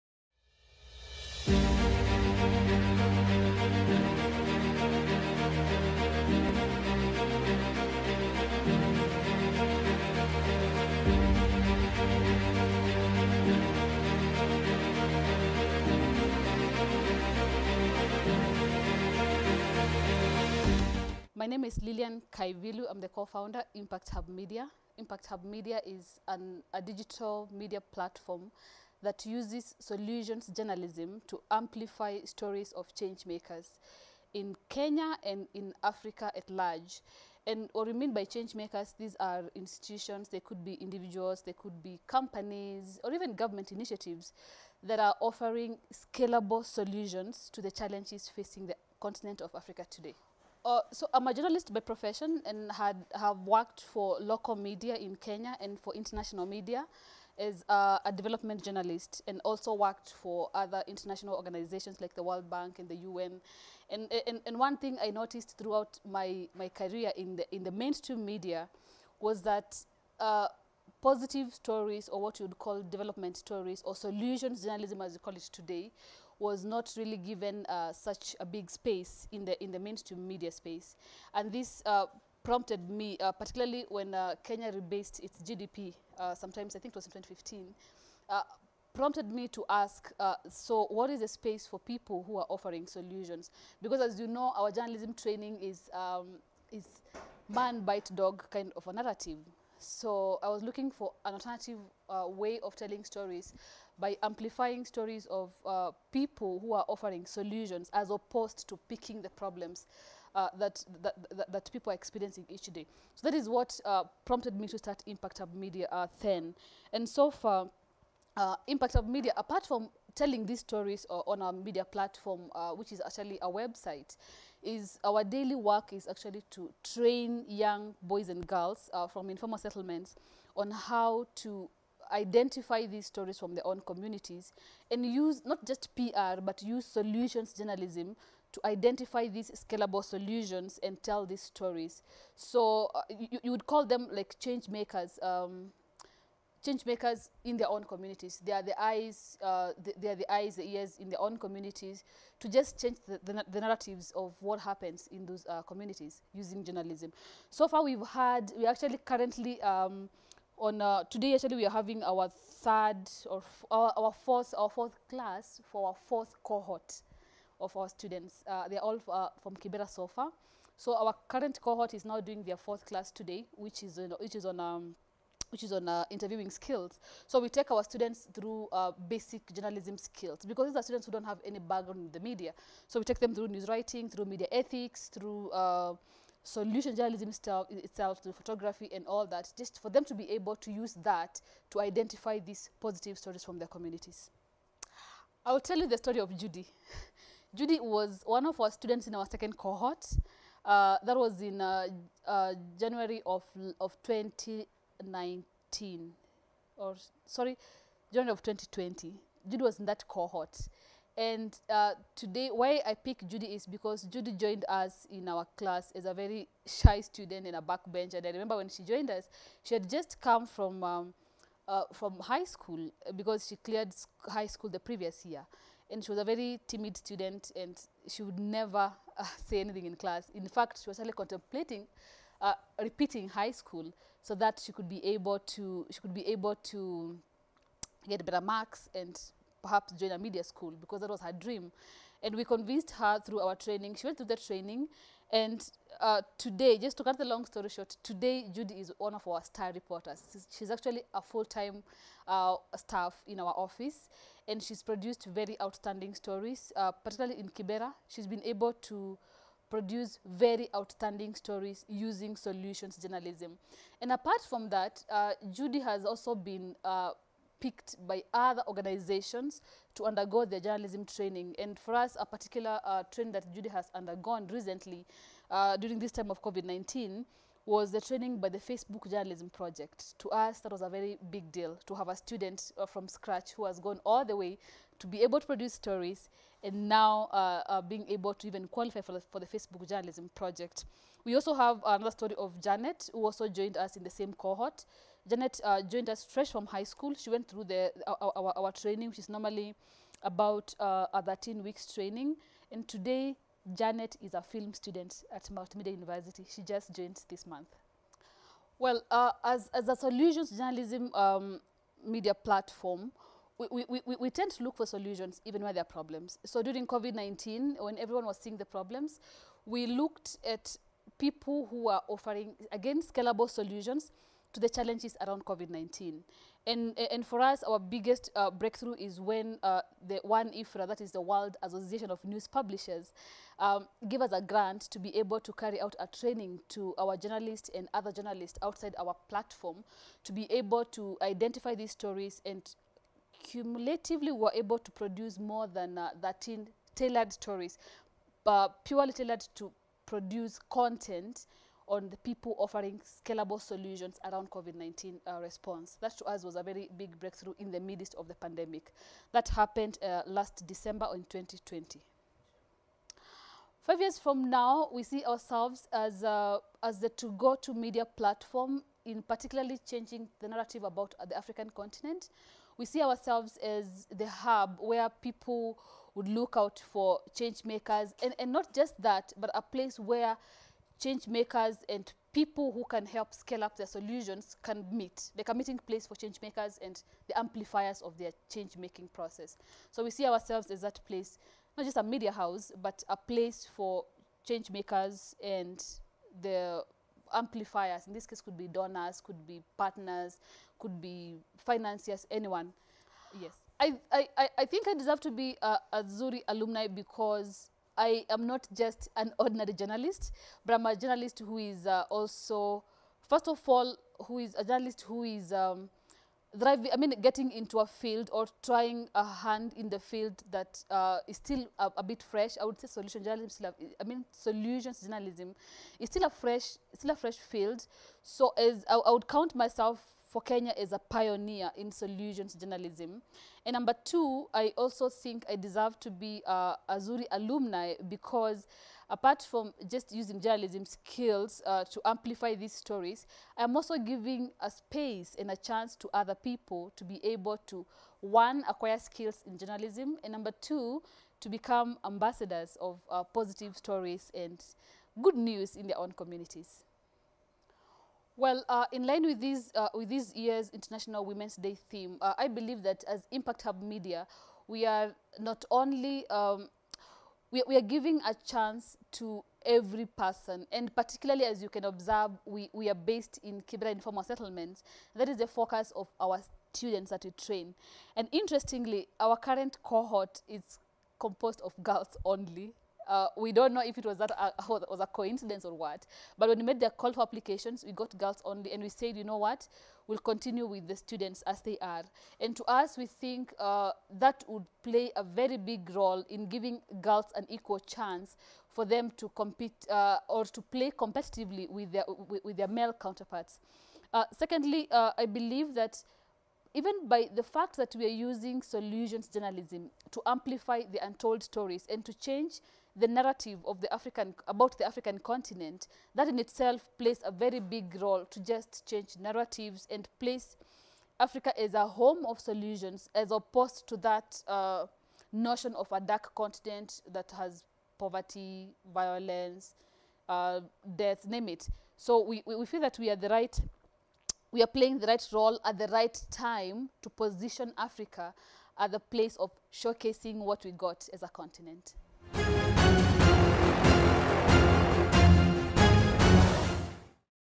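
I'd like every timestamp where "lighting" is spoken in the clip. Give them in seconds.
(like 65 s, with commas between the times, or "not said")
not said.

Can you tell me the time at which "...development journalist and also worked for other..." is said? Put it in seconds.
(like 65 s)
58 s.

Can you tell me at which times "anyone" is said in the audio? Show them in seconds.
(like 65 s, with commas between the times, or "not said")
402 s.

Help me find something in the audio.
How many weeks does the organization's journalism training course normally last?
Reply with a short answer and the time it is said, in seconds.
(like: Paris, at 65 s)
13, at 301 s.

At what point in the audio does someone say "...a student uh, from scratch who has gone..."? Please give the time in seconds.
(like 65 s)
282 s.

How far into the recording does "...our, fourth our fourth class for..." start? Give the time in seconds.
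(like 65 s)
163 s.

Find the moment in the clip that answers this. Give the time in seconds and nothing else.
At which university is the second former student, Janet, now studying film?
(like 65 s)
305 s.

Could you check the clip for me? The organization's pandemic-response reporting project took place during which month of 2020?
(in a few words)
December.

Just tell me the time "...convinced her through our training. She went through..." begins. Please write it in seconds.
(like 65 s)
242 s.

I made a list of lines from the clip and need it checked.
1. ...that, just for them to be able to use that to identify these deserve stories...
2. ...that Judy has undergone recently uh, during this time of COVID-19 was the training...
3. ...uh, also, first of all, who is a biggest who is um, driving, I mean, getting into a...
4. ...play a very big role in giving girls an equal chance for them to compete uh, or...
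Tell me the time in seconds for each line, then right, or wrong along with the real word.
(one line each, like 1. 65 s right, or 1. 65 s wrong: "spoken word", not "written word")
1. 189 s wrong: "positive", not "deserve"
2. 273 s right
3. 411 s wrong: "journalist", not "biggest"
4. 494 s right.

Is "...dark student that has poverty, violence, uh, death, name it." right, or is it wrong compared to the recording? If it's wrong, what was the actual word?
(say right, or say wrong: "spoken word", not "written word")
wrong: "continent", not "student".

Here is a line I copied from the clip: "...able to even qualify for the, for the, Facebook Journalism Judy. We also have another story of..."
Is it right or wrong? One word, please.
wrong.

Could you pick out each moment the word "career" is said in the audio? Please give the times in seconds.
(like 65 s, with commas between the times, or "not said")
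66 s.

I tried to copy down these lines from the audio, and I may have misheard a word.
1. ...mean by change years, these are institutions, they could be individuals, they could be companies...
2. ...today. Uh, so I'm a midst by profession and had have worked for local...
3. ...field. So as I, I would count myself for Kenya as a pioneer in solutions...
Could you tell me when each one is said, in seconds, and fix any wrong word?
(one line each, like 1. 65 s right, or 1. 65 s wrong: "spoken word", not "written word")
1. 37 s wrong: "makers", not "years"
2. 49 s wrong: "journalist", not "midst"
3. 427 s right.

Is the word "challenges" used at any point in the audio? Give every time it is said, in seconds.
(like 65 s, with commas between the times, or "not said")
47 s, 324 s.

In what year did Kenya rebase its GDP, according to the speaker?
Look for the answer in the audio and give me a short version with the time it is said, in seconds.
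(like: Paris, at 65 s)
2015, at 87 s.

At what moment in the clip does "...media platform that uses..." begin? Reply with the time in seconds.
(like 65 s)
27 s.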